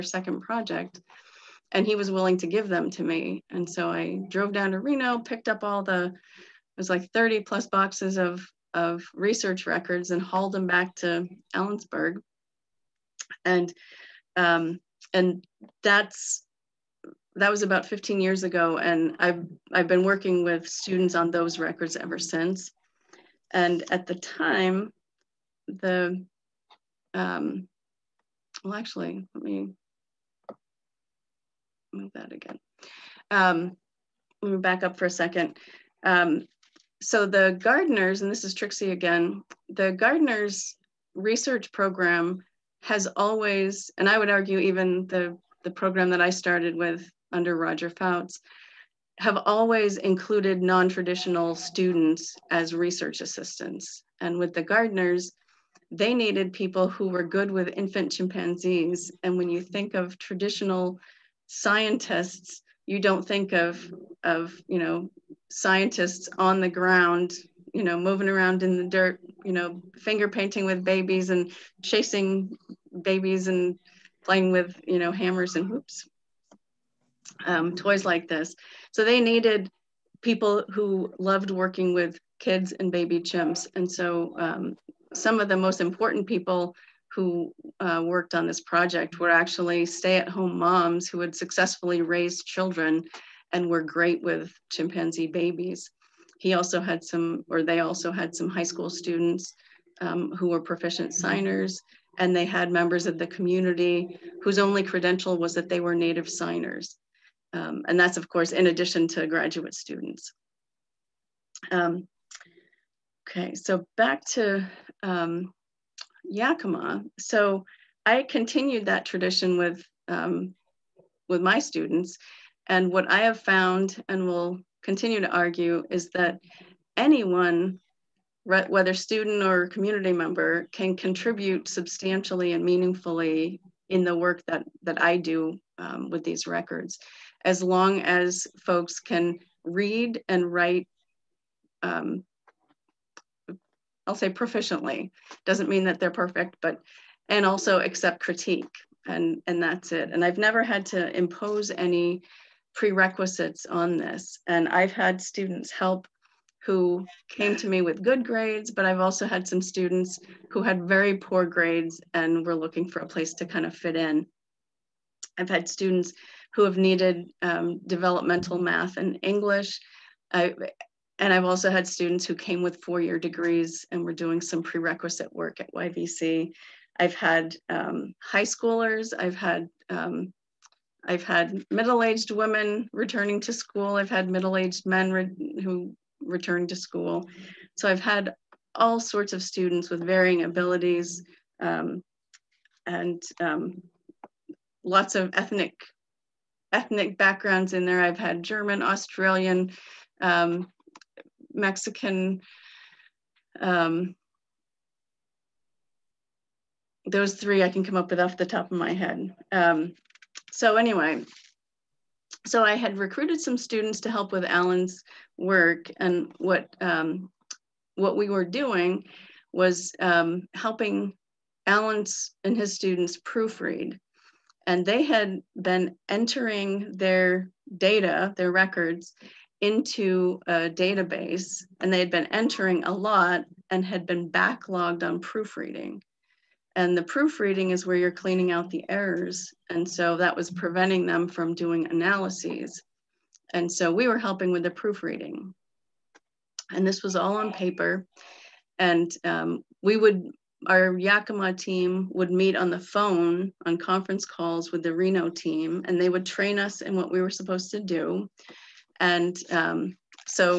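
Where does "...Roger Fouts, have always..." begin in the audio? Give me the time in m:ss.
0:47.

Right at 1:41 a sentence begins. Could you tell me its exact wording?
signers, and they had members of the community whose only credential was that they were native signers.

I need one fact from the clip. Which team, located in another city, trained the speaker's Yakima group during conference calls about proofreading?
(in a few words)
Reno team.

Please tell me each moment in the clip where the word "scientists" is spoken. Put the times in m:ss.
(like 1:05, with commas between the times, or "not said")
1:01, 1:05.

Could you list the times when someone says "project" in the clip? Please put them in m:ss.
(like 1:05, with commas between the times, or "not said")
0:00, 1:28.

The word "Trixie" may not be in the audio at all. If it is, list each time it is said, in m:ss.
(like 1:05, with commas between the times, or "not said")
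0:38.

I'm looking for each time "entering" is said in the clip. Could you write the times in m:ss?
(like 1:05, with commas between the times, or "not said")
3:46, 3:52.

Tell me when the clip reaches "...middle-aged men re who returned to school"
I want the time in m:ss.
3:04.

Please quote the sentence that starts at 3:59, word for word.
And so that was preventing them from doing analyses.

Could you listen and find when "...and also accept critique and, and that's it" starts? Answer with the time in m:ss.
2:27.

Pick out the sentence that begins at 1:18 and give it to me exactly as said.
So they needed people who loved working with kids and baby chimps.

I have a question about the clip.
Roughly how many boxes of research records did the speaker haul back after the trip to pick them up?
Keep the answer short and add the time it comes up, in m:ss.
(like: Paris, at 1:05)
30 plus, at 0:07.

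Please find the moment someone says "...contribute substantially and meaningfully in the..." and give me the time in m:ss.
2:10.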